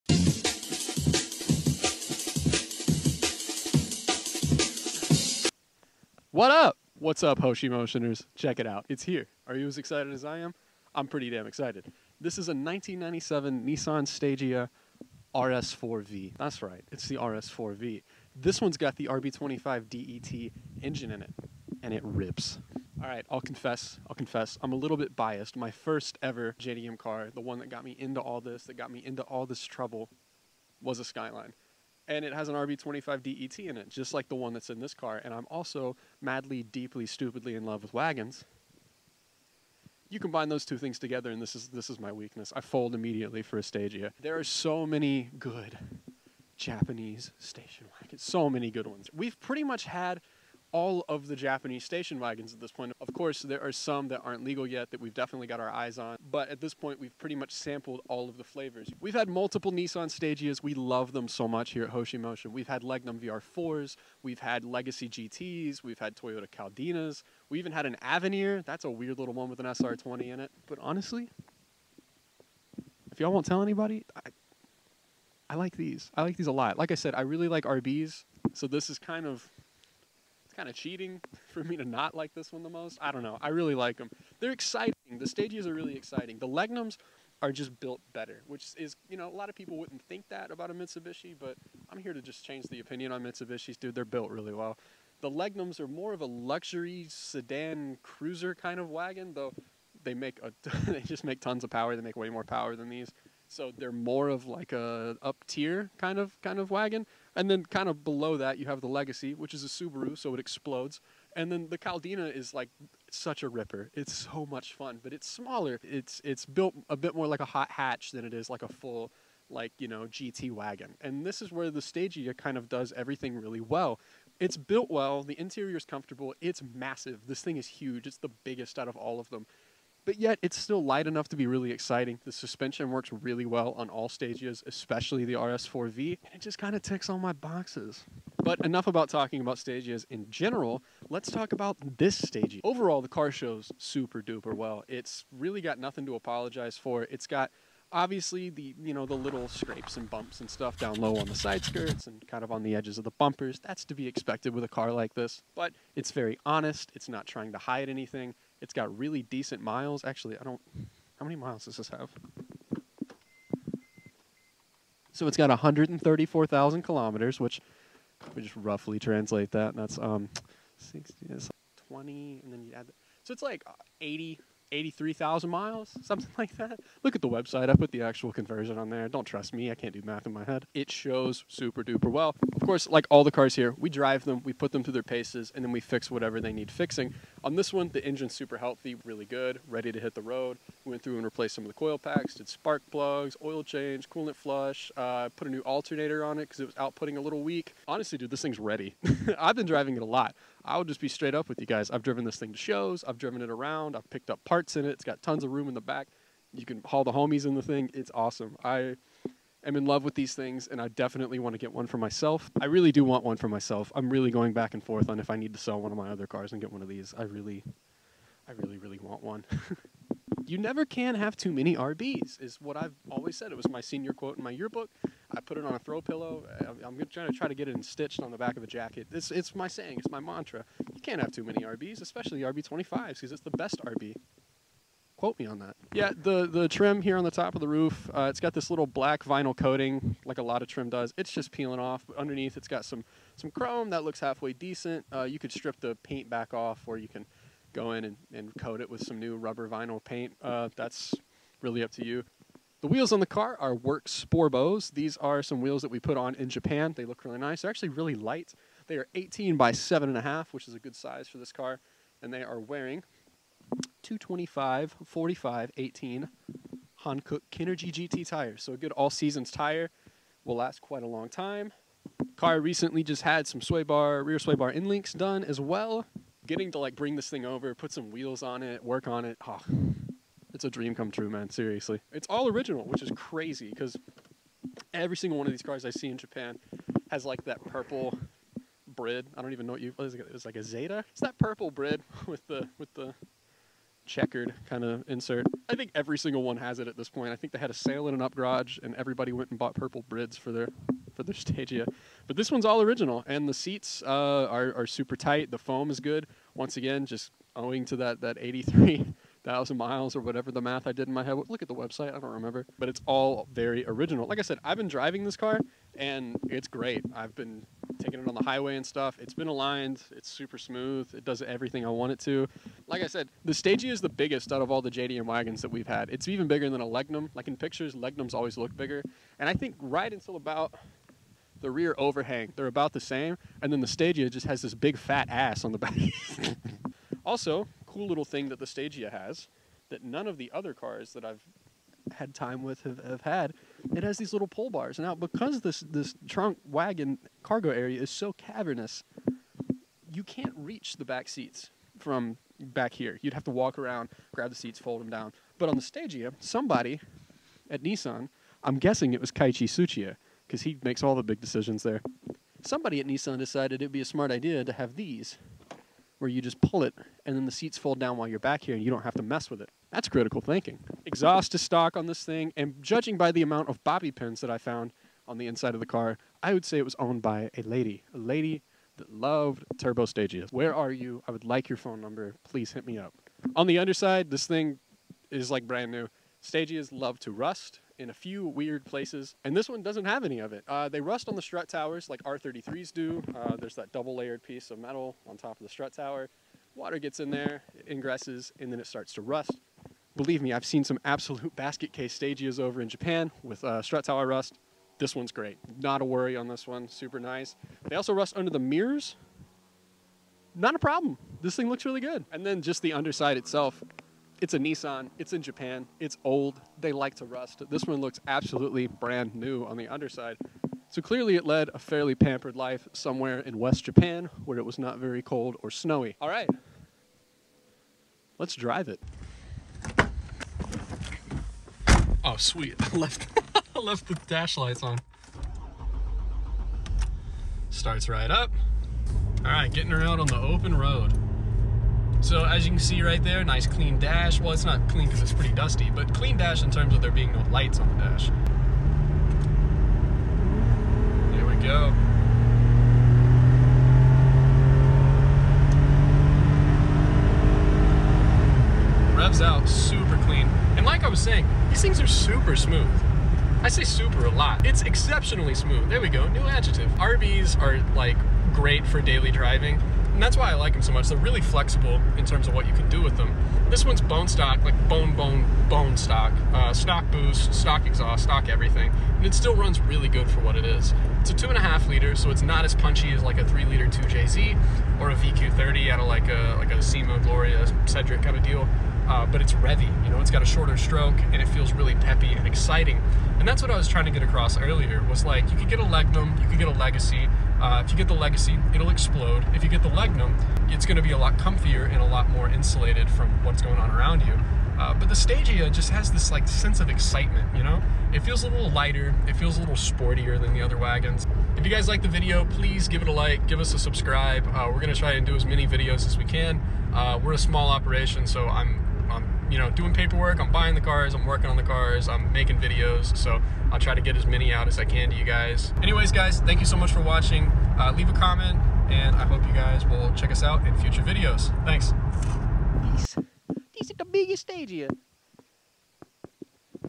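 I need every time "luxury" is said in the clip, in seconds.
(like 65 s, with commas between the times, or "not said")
96 s.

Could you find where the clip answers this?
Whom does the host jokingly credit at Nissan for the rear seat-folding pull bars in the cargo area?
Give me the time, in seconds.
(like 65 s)
359 s.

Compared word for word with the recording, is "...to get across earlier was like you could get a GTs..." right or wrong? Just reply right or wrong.
wrong.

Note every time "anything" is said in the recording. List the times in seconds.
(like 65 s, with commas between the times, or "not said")
157 s.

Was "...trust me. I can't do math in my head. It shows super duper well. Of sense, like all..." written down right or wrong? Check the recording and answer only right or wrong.
wrong.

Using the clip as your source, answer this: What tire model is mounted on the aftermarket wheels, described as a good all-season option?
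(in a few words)
Hankook Kinergy GT.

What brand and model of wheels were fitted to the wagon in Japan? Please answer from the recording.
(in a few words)
Work Sporbos.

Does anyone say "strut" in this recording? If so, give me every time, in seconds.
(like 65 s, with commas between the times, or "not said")
391 s, 395 s, 403 s.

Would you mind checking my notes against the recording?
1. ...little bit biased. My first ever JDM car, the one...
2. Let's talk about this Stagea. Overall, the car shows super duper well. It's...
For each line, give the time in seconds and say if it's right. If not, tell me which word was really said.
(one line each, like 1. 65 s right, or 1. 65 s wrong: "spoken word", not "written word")
1. 24 s right
2. 141 s right.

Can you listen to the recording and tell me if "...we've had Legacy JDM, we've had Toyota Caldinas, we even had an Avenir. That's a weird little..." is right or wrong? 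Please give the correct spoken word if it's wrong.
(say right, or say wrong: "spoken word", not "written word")
wrong: "GTs", not "JDM".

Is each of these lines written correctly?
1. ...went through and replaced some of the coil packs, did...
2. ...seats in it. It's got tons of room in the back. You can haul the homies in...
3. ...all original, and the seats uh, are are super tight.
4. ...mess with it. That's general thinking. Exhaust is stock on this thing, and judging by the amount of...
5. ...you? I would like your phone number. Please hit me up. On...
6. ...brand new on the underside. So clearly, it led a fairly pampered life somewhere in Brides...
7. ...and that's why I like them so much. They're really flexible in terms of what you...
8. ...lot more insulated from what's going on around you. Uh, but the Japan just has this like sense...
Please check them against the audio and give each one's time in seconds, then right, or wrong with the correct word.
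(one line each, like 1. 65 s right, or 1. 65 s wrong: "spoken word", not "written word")
1. 190 s right
2. 204 s wrong: "parts", not "seats"
3. 302 s right
4. 369 s wrong: "critical", not "general"
5. 380 s right
6. 418 s wrong: "West", not "Brides"
7. 470 s right
8. 502 s wrong: "Stagea", not "Japan".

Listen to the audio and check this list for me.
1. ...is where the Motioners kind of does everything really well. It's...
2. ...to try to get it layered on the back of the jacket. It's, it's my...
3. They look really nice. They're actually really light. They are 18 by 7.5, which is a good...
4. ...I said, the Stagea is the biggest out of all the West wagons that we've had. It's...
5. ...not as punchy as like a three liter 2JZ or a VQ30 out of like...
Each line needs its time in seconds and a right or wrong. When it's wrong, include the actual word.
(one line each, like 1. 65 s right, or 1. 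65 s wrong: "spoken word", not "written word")
1. 121 s wrong: "Stagea", not "Motioners"
2. 227 s wrong: "stitched", not "layered"
3. 256 s right
4. 323 s wrong: "JDM", not "West"
5. 482 s right.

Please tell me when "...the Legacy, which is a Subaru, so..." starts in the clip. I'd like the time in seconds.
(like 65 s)
108 s.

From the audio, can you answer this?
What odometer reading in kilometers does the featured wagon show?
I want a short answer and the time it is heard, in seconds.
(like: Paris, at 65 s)
134,000 kilometers, at 165 s.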